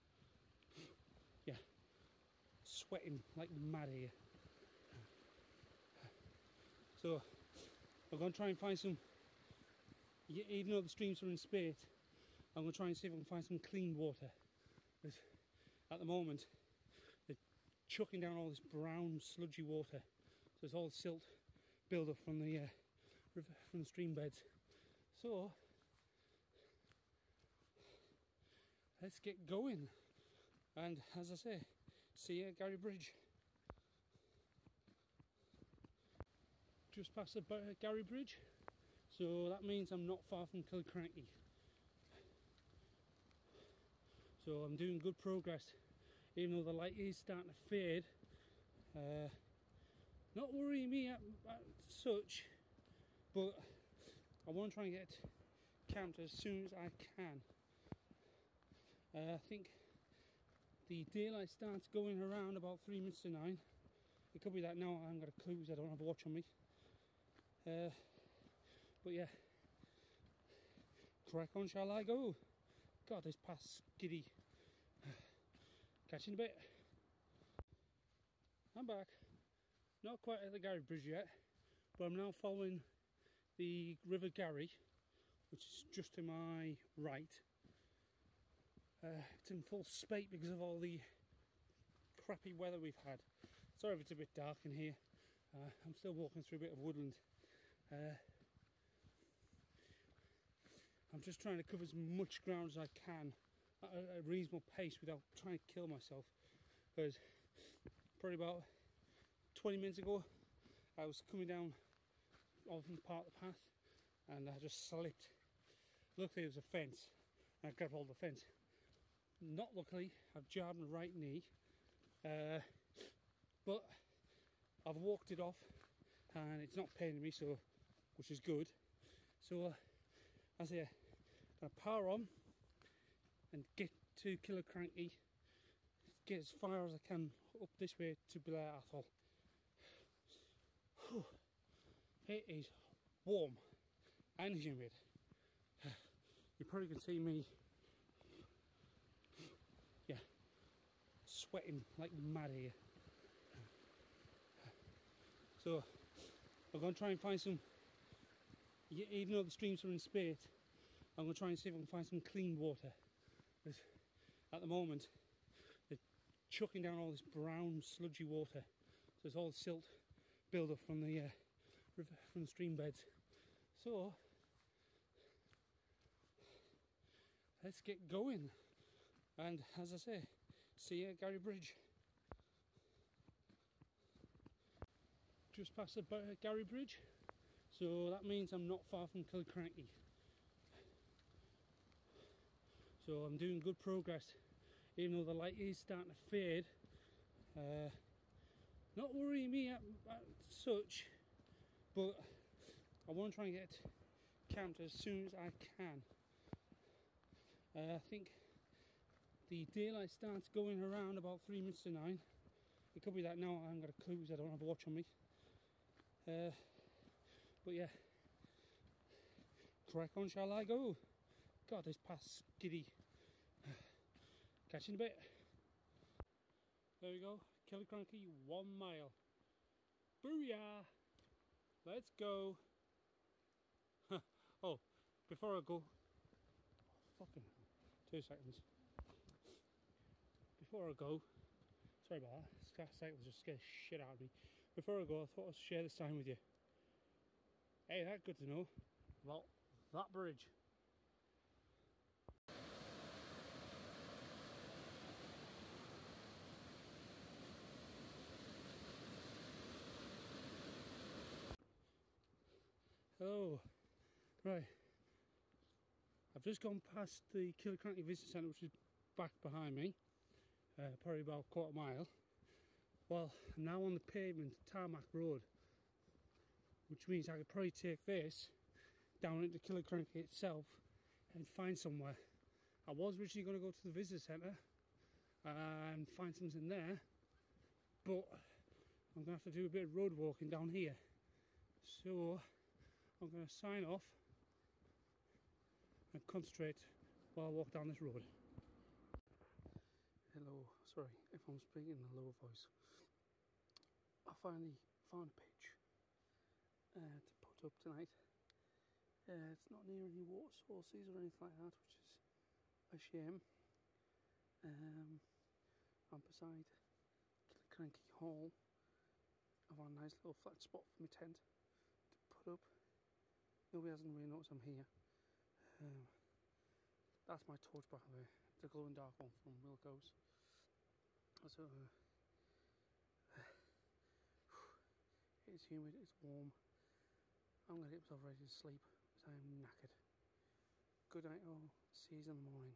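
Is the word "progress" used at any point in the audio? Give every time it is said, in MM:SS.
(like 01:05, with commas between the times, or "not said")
00:45, 03:13.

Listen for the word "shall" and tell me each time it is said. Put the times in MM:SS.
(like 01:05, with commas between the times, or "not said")
01:11, 03:40.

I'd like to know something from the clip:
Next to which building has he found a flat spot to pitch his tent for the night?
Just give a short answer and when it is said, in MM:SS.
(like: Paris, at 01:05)
Cranky Hall, at 05:17.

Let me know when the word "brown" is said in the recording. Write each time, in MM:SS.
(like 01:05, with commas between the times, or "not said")
00:18, 02:47.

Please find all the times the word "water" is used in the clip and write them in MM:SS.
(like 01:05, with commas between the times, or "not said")
00:13, 00:19, 02:42, 02:48, 05:10.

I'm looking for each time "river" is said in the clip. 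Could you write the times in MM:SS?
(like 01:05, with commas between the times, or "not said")
00:23, 01:24, 02:51.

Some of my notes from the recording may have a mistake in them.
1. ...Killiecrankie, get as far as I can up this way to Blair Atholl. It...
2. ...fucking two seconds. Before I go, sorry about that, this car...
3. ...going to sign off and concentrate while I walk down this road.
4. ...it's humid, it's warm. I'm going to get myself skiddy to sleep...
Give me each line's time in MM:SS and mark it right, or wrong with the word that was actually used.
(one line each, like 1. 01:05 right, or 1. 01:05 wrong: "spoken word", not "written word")
1. 02:14 right
2. 03:57 right
3. 04:53 right
4. 05:35 wrong: "ready", not "skiddy".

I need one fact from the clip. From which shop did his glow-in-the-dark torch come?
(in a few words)
Wilko's.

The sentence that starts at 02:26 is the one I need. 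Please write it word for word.
You probably can see me, yeah, sweating like mad here.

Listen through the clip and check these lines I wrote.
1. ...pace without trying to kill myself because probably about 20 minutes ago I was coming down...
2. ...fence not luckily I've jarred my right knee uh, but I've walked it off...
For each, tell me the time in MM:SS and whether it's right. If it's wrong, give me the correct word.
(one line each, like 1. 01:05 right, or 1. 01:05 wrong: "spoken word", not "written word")
1. 01:44 right
2. 01:58 right.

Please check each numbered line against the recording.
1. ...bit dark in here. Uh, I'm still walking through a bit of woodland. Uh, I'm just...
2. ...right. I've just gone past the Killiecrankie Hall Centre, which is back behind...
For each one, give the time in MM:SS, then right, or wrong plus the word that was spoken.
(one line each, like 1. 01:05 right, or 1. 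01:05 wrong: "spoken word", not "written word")
1. 01:34 right
2. 04:24 wrong: "Visitor", not "Hall".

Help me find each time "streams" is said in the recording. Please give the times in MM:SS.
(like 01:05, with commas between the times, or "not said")
00:10, 00:23, 02:39, 02:52.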